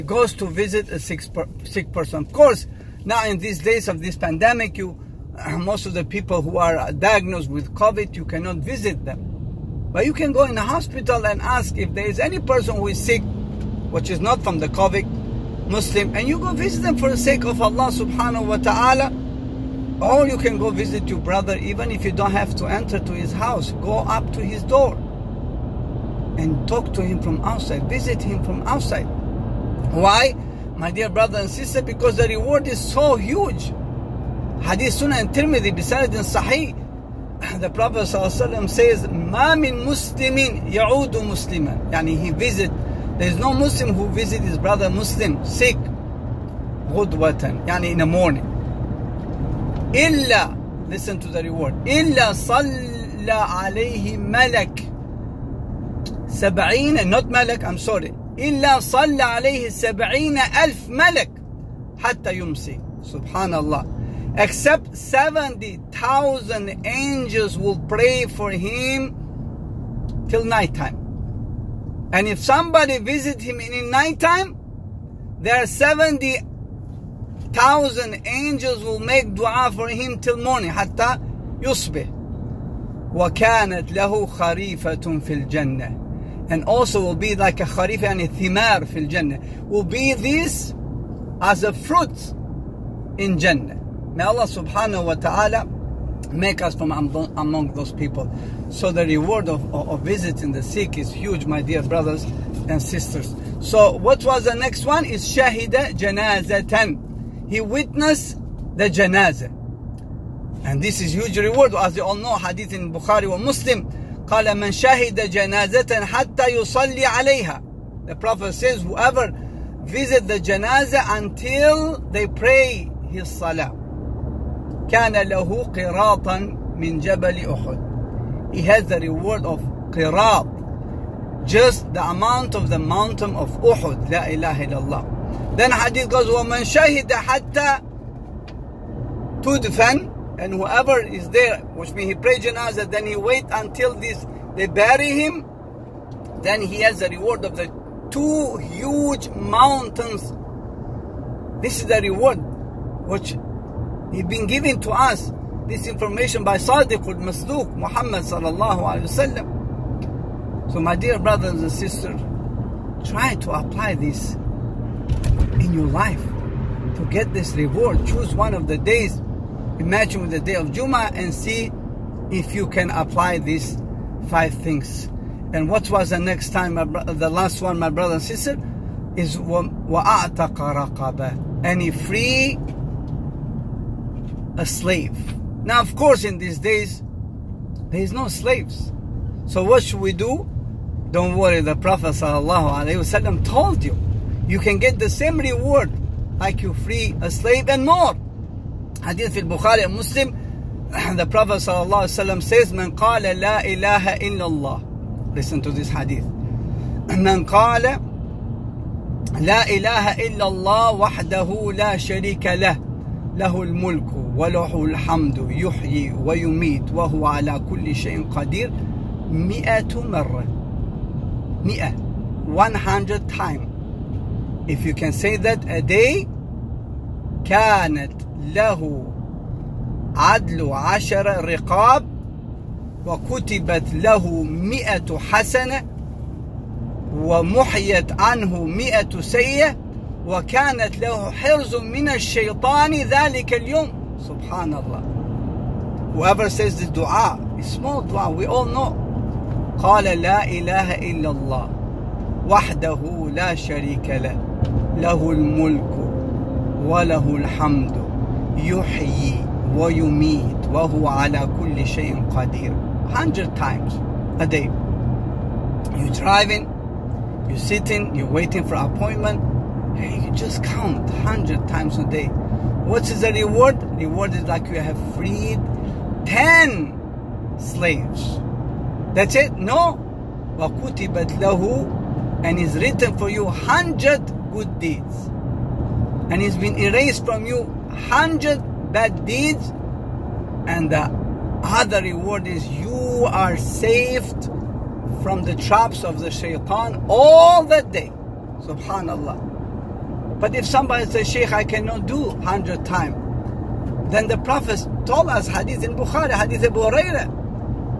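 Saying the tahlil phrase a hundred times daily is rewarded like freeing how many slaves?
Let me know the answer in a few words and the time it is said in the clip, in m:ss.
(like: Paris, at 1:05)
10, at 4:36.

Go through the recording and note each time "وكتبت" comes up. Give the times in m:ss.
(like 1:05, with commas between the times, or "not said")
3:53, 4:40.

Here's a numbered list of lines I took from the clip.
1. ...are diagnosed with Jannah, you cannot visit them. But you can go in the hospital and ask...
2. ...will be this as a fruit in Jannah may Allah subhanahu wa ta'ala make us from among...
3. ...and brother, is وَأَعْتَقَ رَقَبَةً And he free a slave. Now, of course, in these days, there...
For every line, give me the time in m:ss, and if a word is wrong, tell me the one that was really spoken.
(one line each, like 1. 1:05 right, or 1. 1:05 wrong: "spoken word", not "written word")
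1. 0:06 wrong: "COVID", not "Jannah"
2. 1:29 right
3. 2:58 wrong: "sister", not "brother".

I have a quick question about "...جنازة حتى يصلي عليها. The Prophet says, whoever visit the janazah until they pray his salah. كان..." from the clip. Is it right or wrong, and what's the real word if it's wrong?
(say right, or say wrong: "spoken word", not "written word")
right.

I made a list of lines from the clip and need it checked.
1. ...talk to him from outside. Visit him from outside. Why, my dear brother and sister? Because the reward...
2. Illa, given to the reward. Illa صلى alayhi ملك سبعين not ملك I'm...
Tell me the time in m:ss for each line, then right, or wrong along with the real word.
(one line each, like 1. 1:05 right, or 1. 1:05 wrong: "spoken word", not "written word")
1. 0:26 right
2. 0:49 wrong: "listen", not "given".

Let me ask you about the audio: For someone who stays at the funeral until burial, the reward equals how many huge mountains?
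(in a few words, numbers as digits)
2.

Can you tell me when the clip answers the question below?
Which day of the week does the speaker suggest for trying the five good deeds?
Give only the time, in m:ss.
2:50.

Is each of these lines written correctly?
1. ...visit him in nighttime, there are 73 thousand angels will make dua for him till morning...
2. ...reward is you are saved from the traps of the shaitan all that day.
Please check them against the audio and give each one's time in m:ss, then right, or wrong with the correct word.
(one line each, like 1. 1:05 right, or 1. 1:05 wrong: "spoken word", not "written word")
1. 1:12 wrong: "70", not "73"
2. 4:52 right.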